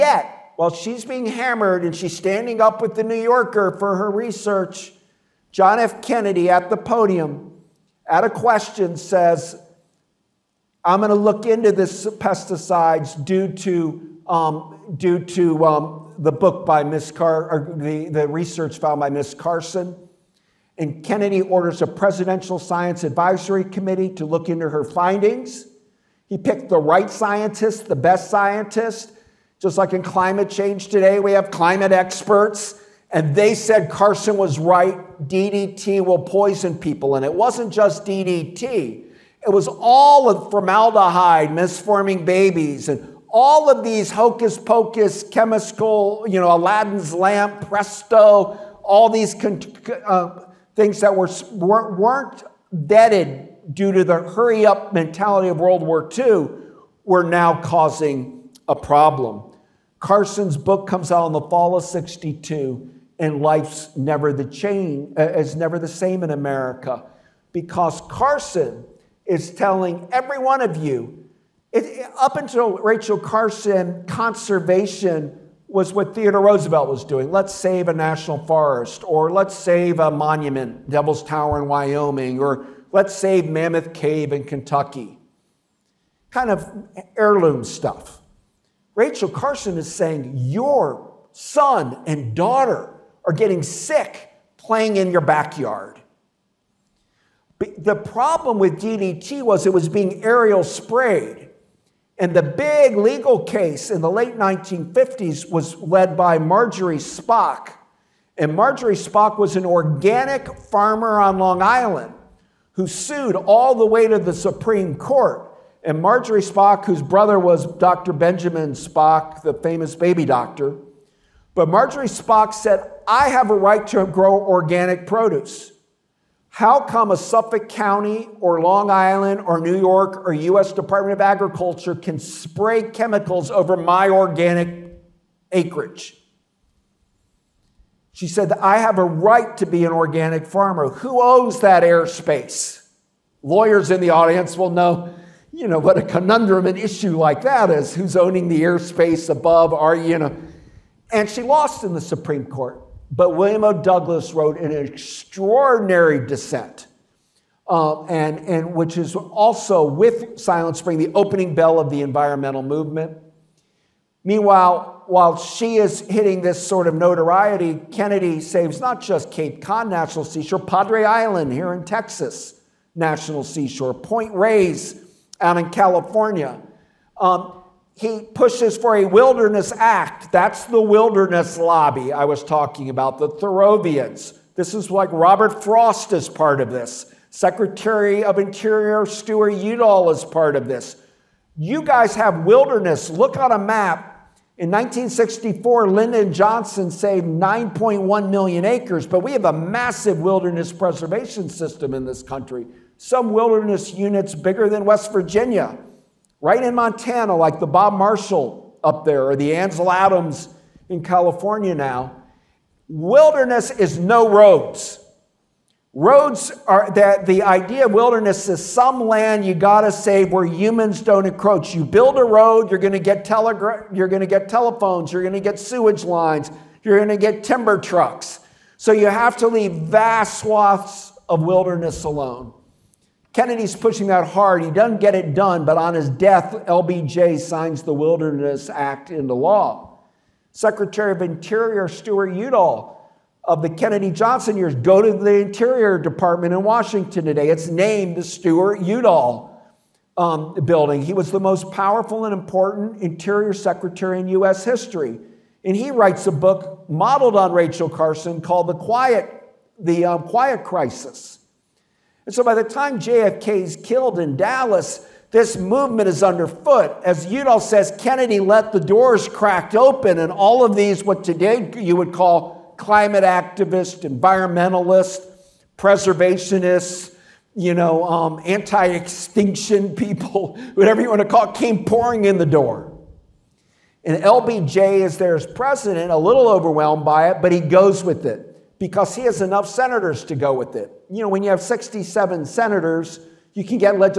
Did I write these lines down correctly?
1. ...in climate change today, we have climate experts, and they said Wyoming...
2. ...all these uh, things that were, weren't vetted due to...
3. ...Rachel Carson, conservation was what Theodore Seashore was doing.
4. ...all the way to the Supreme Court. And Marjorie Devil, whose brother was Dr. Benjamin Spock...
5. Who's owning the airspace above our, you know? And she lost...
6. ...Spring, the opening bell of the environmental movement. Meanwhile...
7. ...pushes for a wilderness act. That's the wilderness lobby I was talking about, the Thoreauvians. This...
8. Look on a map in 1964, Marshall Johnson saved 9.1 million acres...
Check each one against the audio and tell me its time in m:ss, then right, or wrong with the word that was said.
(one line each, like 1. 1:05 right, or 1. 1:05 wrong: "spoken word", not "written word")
1. 0:29 wrong: "Carson", not "Wyoming"
2. 0:48 right
3. 1:12 wrong: "Roosevelt", not "Seashore"
4. 1:53 wrong: "Spock", not "Devil"
5. 2:27 right
6. 2:40 right
7. 2:58 right
8. 3:13 wrong: "Lyndon", not "Marshall".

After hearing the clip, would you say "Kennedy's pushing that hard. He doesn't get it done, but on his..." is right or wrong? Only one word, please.
right.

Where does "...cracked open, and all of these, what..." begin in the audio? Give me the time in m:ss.
4:29.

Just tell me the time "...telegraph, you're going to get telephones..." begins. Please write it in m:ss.
3:43.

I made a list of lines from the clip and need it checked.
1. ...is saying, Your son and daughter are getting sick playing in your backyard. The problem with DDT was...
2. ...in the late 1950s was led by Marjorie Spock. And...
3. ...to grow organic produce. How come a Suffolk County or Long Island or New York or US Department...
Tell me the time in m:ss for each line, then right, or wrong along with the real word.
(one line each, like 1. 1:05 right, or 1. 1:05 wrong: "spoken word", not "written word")
1. 1:29 right
2. 1:43 right
3. 2:03 right.